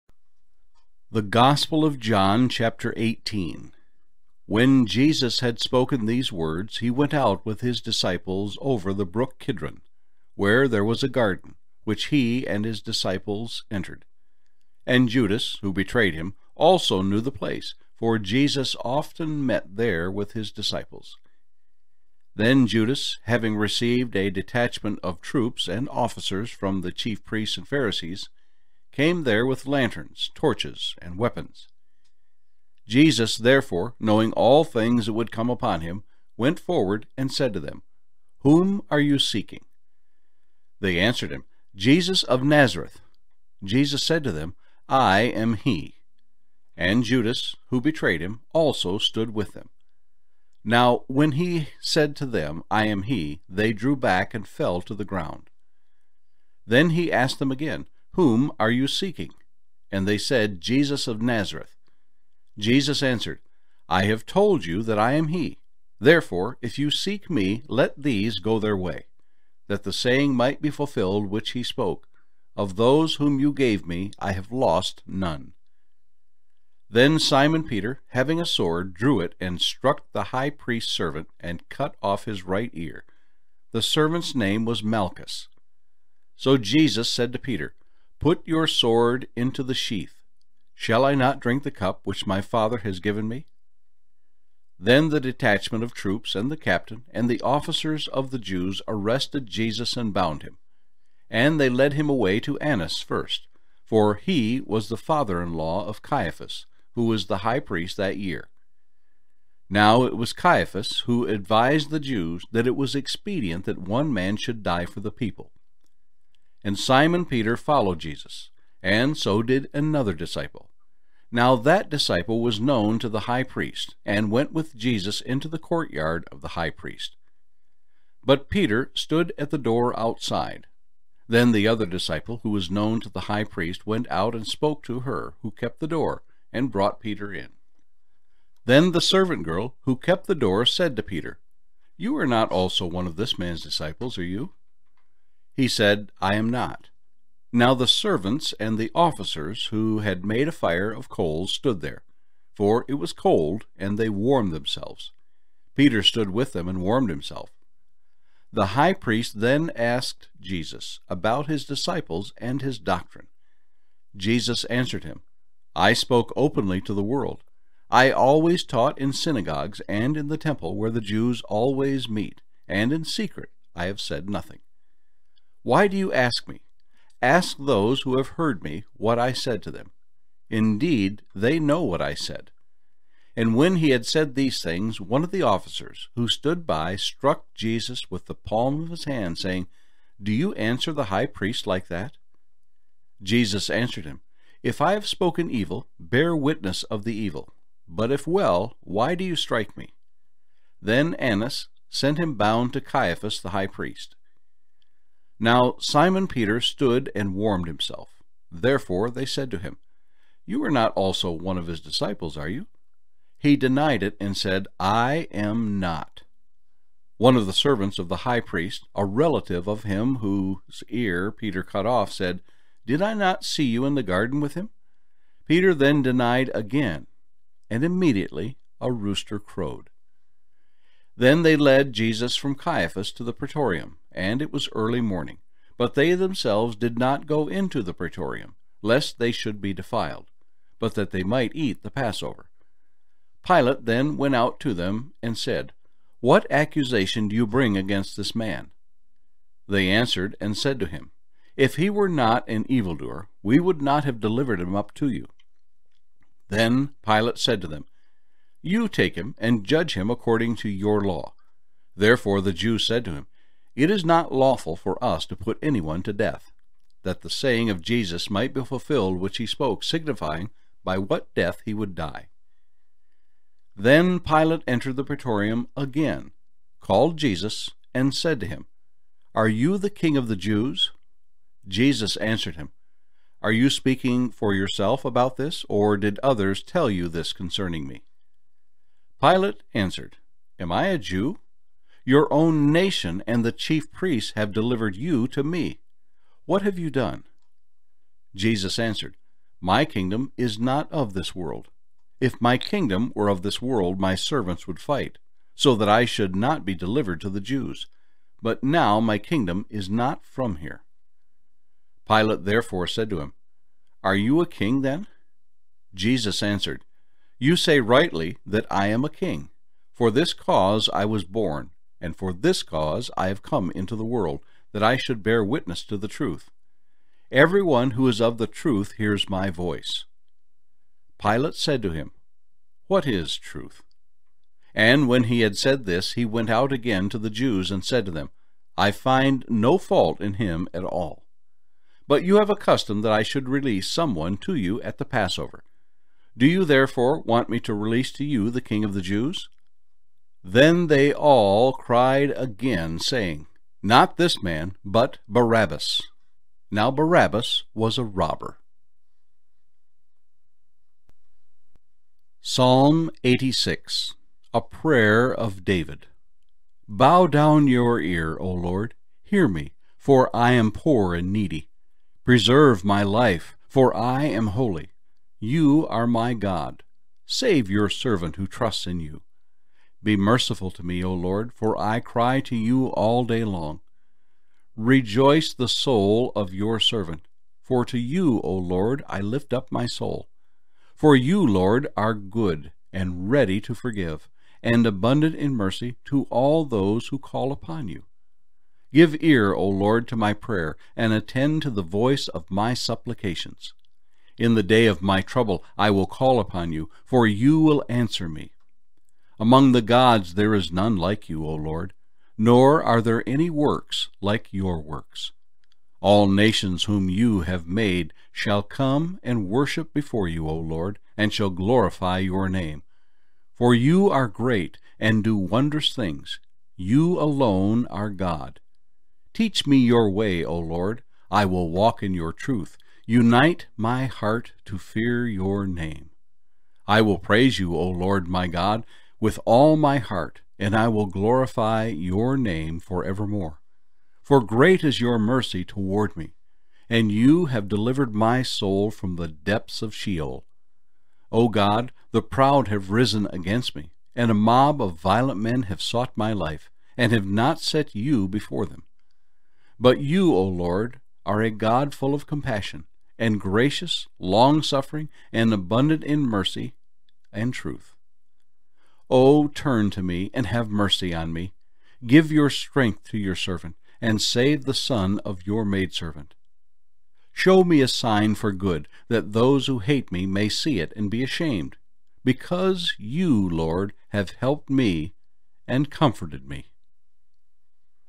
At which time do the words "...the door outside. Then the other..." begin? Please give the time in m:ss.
2:09.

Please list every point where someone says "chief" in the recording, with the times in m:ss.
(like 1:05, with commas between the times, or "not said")
0:26, 4:53.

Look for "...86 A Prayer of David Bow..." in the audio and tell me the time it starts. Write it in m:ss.
6:03.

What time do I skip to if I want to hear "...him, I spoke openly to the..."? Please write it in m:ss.
2:45.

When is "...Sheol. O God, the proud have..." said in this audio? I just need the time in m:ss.
7:29.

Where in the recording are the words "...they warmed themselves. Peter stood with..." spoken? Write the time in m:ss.
2:33.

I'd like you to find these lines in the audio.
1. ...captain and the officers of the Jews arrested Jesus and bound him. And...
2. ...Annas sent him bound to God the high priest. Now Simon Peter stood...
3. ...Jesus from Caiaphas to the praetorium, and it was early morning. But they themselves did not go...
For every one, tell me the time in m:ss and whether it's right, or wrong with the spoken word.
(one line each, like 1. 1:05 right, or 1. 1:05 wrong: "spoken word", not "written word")
1. 1:36 right
2. 3:21 wrong: "Caiaphas", not "God"
3. 3:51 right.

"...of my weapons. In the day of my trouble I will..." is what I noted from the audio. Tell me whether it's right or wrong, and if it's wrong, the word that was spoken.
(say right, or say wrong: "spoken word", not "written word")
wrong: "supplications", not "weapons".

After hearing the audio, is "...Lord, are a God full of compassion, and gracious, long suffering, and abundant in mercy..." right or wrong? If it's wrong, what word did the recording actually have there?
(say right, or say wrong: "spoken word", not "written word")
right.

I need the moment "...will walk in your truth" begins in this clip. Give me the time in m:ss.
7:11.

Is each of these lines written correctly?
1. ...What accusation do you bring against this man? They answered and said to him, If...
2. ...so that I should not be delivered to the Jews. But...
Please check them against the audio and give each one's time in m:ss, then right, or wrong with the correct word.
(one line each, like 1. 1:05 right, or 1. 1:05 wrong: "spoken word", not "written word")
1. 4:06 right
2. 5:05 right.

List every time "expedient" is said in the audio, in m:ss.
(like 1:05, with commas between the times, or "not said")
1:52.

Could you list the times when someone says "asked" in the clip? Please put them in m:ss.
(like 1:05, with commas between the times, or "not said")
0:57, 2:39.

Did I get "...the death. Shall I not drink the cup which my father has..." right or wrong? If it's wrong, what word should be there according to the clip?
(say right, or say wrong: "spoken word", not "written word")
wrong: "sheath", not "death".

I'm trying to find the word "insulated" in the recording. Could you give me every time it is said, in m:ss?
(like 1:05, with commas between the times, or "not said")
not said.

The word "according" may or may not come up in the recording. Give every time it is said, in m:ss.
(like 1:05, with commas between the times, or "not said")
4:20.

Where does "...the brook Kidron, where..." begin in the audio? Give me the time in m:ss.
0:08.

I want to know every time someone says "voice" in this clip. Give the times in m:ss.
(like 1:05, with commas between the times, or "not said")
5:29, 6:41.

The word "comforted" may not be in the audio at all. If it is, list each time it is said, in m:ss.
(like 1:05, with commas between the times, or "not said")
8:05.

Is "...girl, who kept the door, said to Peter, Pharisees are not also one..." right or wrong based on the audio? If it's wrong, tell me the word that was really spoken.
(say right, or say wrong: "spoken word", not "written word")
wrong: "You", not "Pharisees".